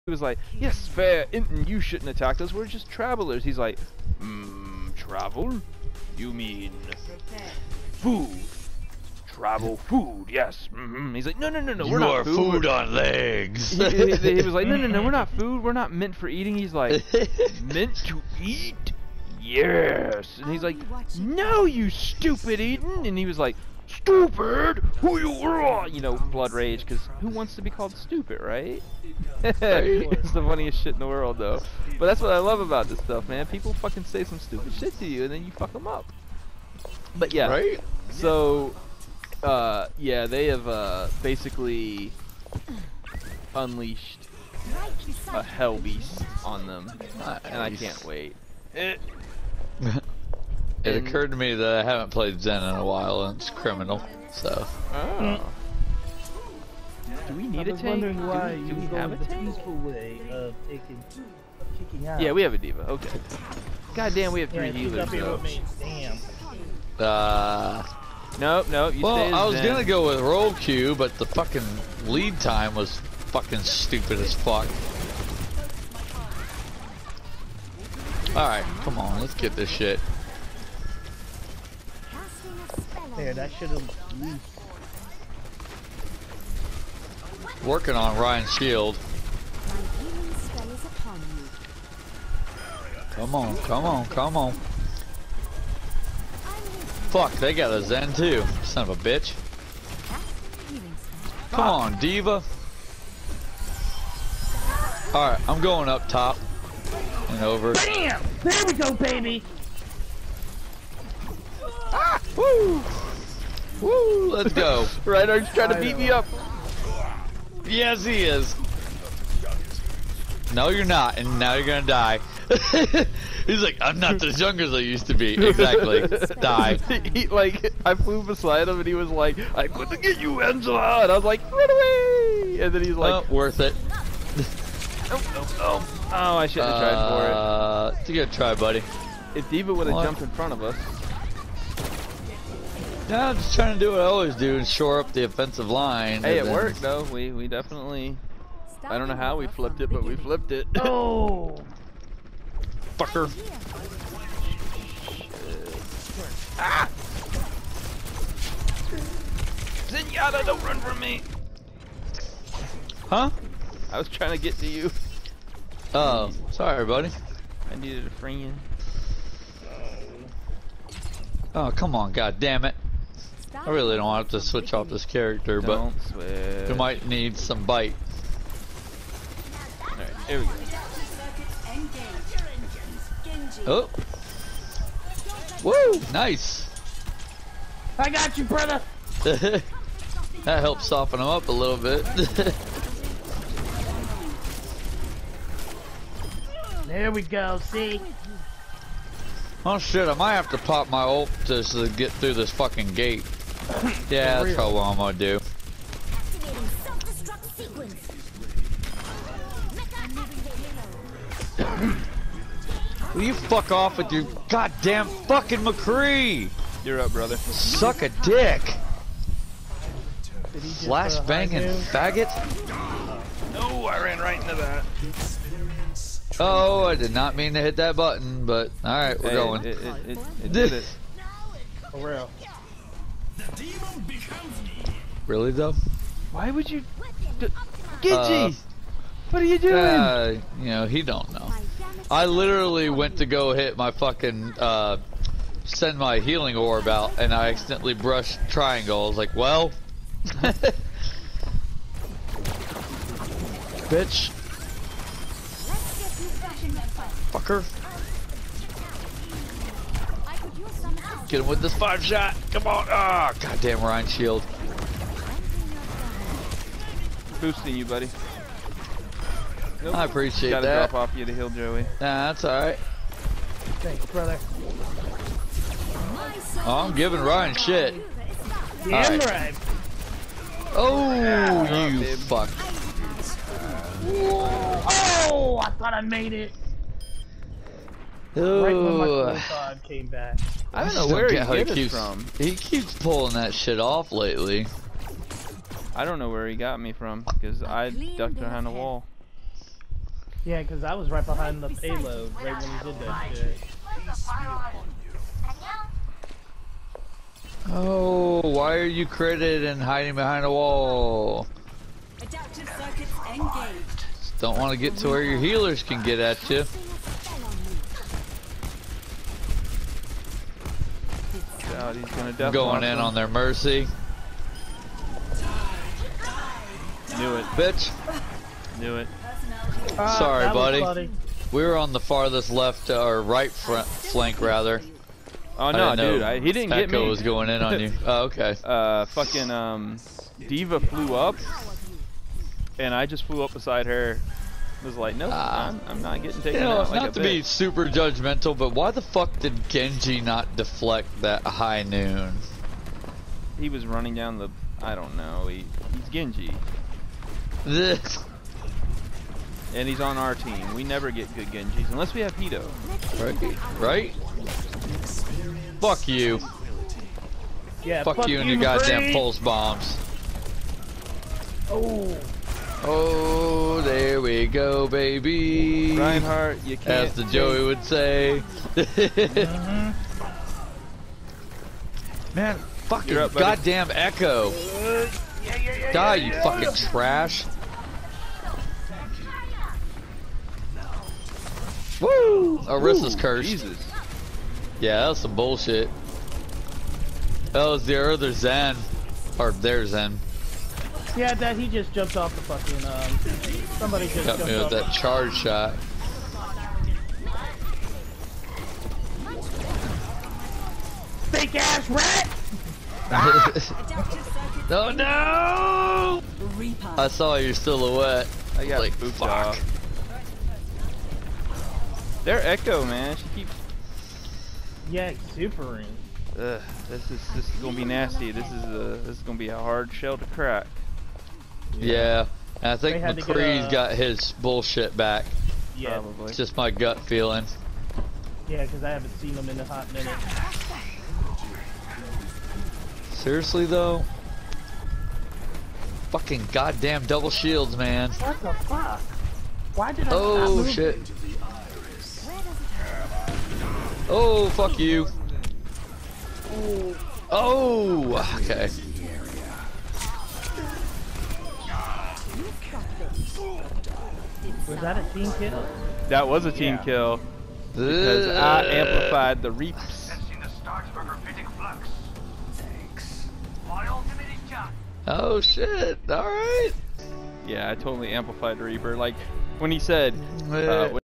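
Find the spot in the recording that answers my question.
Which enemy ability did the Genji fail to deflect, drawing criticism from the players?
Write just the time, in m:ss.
5:51.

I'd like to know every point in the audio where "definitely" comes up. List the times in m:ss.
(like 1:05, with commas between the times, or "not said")
2:27, 5:22.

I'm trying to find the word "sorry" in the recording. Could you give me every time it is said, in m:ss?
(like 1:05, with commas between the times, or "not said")
2:46, 5:30.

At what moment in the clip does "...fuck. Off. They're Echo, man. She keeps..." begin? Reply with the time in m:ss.
6:58.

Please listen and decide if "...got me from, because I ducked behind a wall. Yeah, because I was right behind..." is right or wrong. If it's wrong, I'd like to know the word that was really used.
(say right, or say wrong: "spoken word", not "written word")
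right.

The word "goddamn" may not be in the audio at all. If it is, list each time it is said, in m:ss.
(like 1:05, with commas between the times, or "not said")
3:34, 4:23, 6:08, 6:23, 7:26.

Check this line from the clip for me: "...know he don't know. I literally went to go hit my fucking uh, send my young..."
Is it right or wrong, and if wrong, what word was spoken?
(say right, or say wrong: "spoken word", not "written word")
wrong: "healing", not "young".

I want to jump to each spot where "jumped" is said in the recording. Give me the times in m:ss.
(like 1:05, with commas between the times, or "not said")
2:20, 6:41.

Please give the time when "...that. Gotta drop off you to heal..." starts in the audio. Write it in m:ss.
4:30.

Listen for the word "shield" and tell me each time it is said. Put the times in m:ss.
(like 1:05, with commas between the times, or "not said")
1:28, 4:24, 7:27.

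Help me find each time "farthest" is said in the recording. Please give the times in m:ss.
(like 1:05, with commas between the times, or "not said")
5:31.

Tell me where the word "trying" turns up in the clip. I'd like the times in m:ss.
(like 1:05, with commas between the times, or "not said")
1:55, 2:23, 2:44.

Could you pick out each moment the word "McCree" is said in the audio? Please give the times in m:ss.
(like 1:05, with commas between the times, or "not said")
3:35, 7:13.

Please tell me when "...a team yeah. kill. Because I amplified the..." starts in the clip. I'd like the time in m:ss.
7:46.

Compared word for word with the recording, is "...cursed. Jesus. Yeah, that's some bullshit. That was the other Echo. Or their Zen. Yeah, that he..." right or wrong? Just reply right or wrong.
wrong.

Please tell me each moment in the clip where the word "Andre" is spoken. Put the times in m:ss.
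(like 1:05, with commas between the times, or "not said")
not said.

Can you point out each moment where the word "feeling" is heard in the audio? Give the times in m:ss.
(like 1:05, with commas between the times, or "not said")
7:17.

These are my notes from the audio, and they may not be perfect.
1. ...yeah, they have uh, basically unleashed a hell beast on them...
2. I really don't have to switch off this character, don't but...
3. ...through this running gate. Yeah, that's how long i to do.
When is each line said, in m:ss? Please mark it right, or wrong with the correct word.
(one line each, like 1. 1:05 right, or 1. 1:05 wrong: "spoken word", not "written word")
1. 0:39 right
2. 2:53 right
3. 3:22 wrong: "fucking", not "running".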